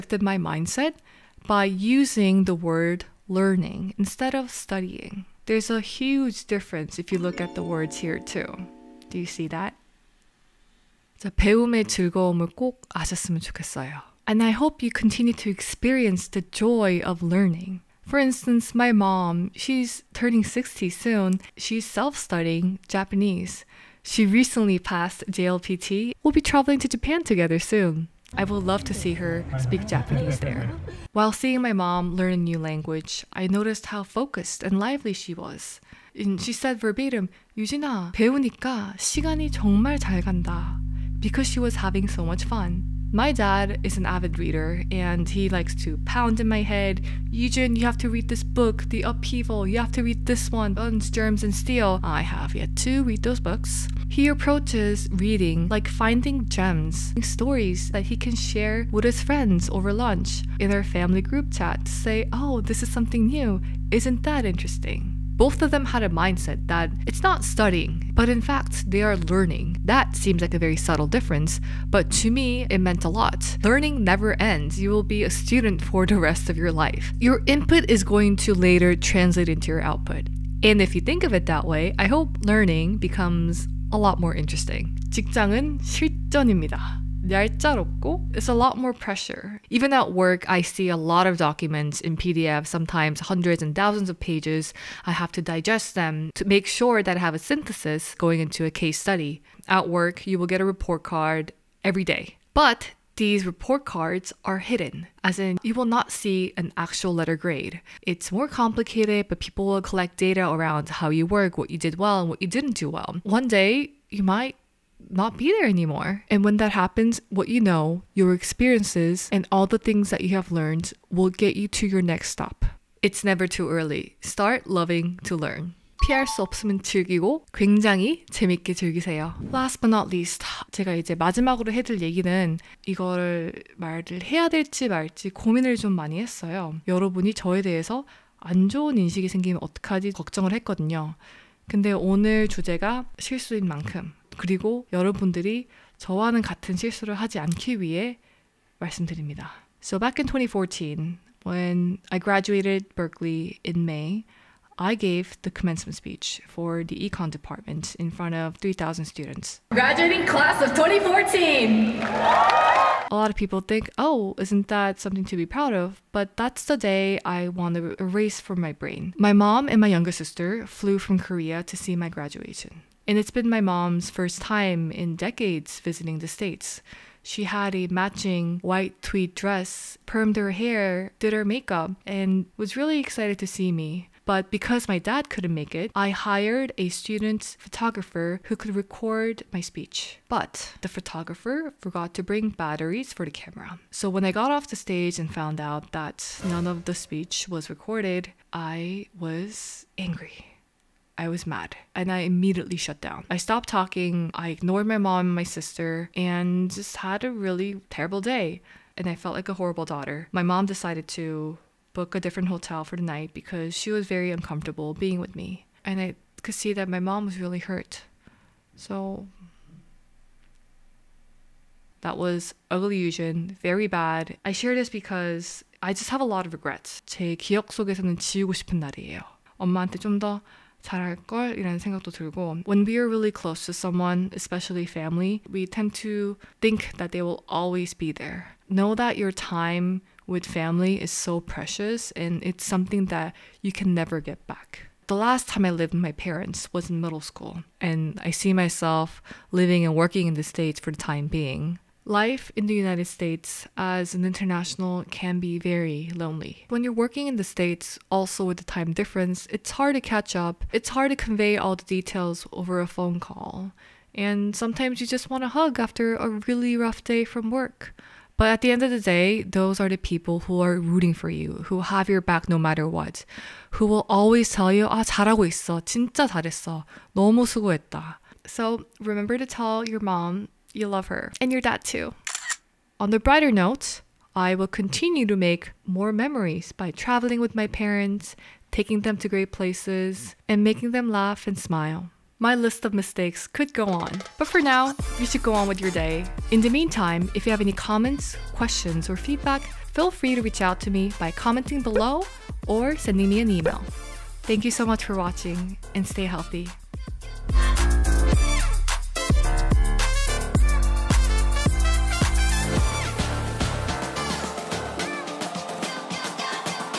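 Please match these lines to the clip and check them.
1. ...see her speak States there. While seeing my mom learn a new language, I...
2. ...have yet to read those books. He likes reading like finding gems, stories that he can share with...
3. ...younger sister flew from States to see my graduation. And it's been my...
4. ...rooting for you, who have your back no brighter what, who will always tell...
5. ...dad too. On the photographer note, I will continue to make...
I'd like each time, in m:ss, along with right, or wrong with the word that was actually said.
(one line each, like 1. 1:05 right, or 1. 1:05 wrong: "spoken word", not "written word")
1. 0:28 wrong: "Japanese", not "States"
2. 0:52 wrong: "approaches", not "likes"
3. 2:49 wrong: "Korea", not "States"
4. 4:30 wrong: "matter", not "brighter"
5. 4:41 wrong: "brighter", not "photographer".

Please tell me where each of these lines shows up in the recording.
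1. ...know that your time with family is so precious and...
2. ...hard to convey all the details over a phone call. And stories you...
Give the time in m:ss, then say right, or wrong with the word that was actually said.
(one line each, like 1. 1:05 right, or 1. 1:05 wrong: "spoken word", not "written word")
1. 3:58 right
2. 4:20 wrong: "sometimes", not "stories".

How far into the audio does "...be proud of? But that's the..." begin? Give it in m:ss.
2:45.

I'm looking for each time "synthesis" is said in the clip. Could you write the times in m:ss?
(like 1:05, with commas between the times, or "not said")
1:37.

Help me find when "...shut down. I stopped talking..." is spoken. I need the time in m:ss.
3:22.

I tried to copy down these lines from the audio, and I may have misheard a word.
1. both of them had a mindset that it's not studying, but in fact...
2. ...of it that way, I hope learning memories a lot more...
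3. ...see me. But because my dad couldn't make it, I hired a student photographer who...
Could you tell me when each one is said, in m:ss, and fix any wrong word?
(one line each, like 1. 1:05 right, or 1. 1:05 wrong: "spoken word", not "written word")
1. 1:05 right
2. 1:21 wrong: "becomes", not "memories"
3. 3:03 right.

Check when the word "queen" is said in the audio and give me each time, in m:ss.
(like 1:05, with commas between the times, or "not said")
not said.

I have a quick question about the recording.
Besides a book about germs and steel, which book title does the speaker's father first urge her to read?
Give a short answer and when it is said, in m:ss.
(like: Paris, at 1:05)
The Upheaval, at 0:48.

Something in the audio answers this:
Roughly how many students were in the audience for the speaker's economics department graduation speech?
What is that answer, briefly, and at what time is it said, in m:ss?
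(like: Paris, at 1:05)
3,000, at 2:38.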